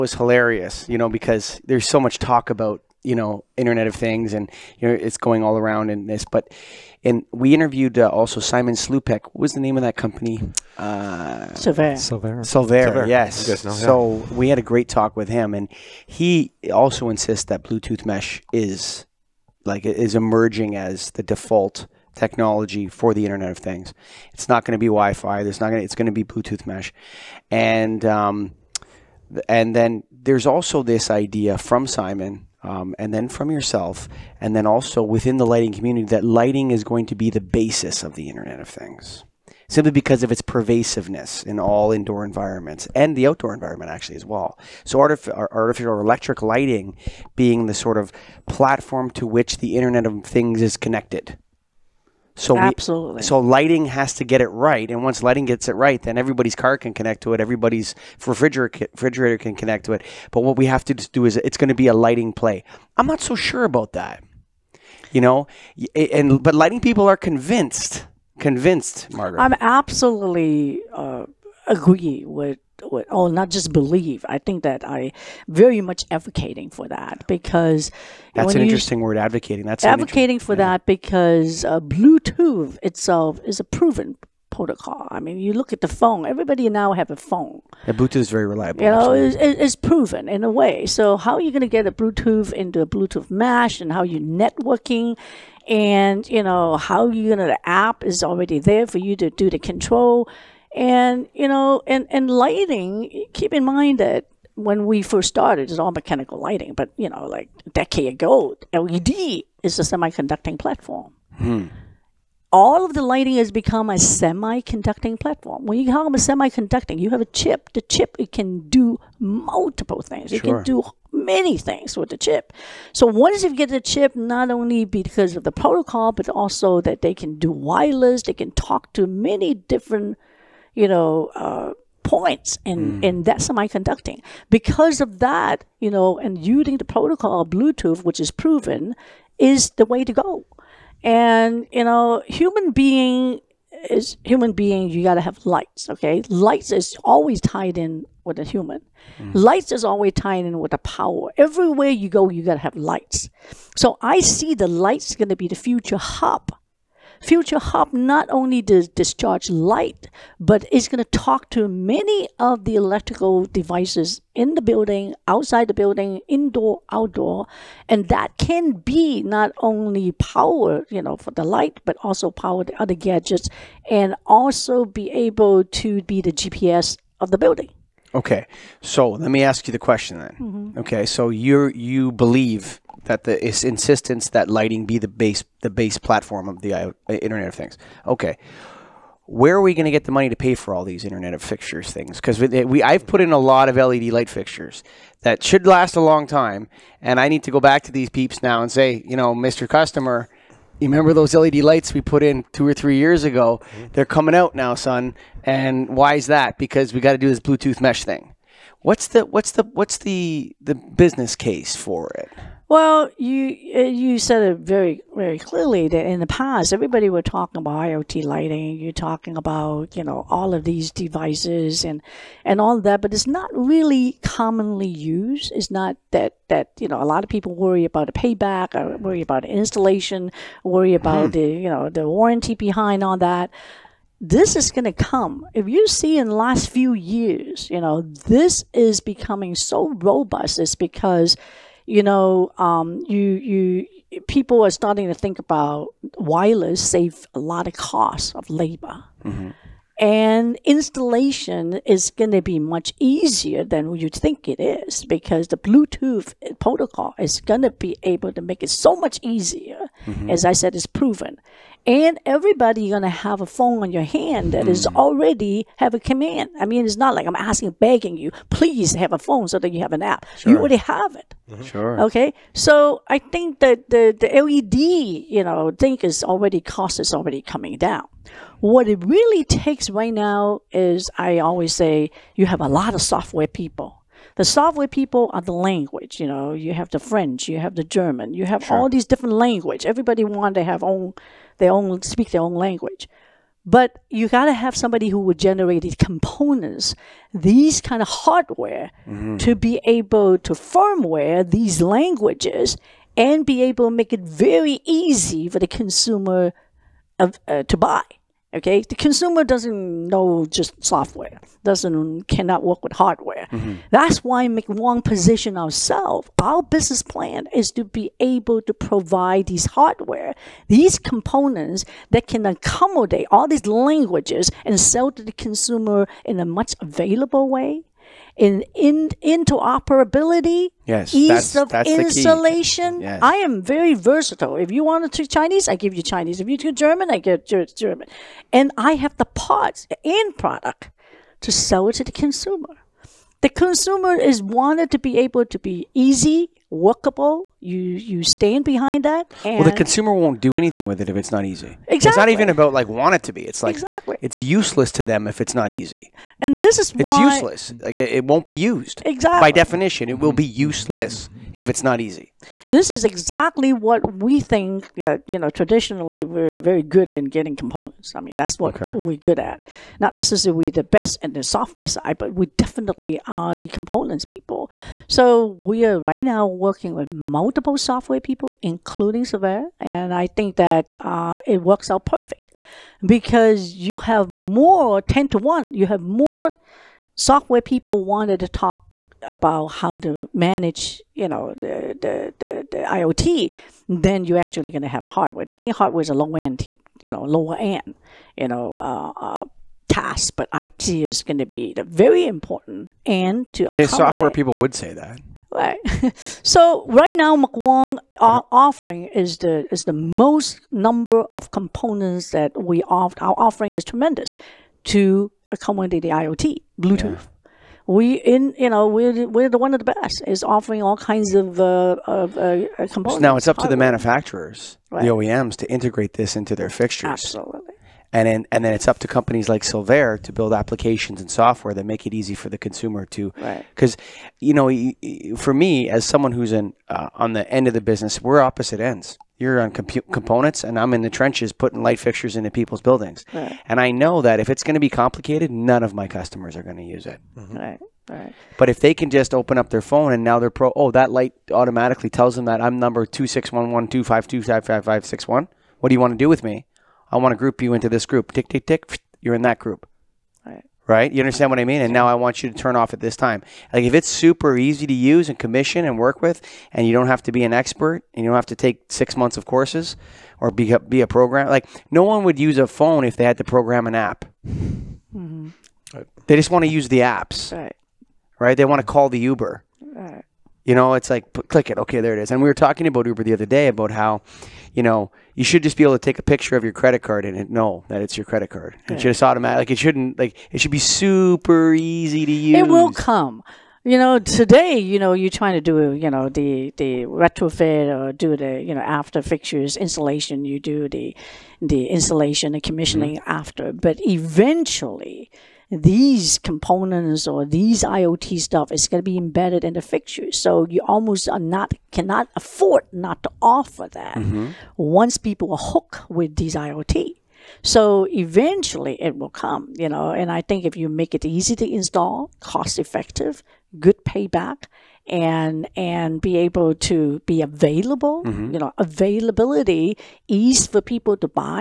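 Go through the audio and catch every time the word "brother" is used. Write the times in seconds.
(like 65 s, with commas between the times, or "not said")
not said.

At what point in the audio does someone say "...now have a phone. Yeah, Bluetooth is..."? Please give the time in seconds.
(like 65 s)
86 s.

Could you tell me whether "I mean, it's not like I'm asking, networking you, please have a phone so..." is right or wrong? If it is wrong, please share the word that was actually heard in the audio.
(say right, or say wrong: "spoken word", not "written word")
wrong: "begging", not "networking".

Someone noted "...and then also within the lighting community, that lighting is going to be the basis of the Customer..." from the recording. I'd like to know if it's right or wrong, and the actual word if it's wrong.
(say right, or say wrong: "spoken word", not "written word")
wrong: "Internet", not "Customer".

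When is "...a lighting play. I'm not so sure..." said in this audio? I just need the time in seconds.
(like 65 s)
61 s.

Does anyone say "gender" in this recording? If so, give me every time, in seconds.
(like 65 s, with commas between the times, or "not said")
not said.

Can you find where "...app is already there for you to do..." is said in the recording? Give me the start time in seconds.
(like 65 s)
97 s.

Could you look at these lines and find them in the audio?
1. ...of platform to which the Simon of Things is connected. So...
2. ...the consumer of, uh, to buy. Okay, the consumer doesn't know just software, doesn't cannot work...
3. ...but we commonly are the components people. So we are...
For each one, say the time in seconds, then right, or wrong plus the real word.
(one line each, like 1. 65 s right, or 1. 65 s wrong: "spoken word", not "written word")
1. 47 s wrong: "Internet", not "Simon"
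2. 305 s right
3. 372 s wrong: "definitely", not "commonly".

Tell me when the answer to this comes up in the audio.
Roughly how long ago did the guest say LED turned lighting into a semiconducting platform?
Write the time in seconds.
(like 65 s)
107 s.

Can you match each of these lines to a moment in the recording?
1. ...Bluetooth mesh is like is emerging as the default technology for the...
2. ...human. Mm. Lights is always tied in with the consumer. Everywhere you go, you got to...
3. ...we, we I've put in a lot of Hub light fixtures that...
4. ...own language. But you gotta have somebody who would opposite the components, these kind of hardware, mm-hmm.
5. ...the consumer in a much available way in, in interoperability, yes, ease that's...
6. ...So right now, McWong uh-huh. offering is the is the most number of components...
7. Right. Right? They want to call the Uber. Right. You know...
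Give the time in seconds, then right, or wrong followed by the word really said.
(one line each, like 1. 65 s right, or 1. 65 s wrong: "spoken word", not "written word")
1. 17 s right
2. 148 s wrong: "power", not "consumer"
3. 192 s wrong: "LED", not "Hub"
4. 292 s wrong: "generate", not "opposite"
5. 325 s right
6. 406 s right
7. 477 s right.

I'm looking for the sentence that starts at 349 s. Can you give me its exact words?
well, the consumer won't do anything with it if it's not easy.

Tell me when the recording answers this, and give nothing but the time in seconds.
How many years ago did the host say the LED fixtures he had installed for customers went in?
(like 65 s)
202 s.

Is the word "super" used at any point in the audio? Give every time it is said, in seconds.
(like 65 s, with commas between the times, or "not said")
464 s, 490 s.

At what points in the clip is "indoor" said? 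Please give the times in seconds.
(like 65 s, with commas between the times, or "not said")
41 s, 166 s.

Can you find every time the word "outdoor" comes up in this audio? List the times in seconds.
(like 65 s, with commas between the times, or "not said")
43 s, 166 s.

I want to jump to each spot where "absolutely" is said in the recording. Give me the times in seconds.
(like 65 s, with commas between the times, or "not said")
52 s, 69 s, 427 s.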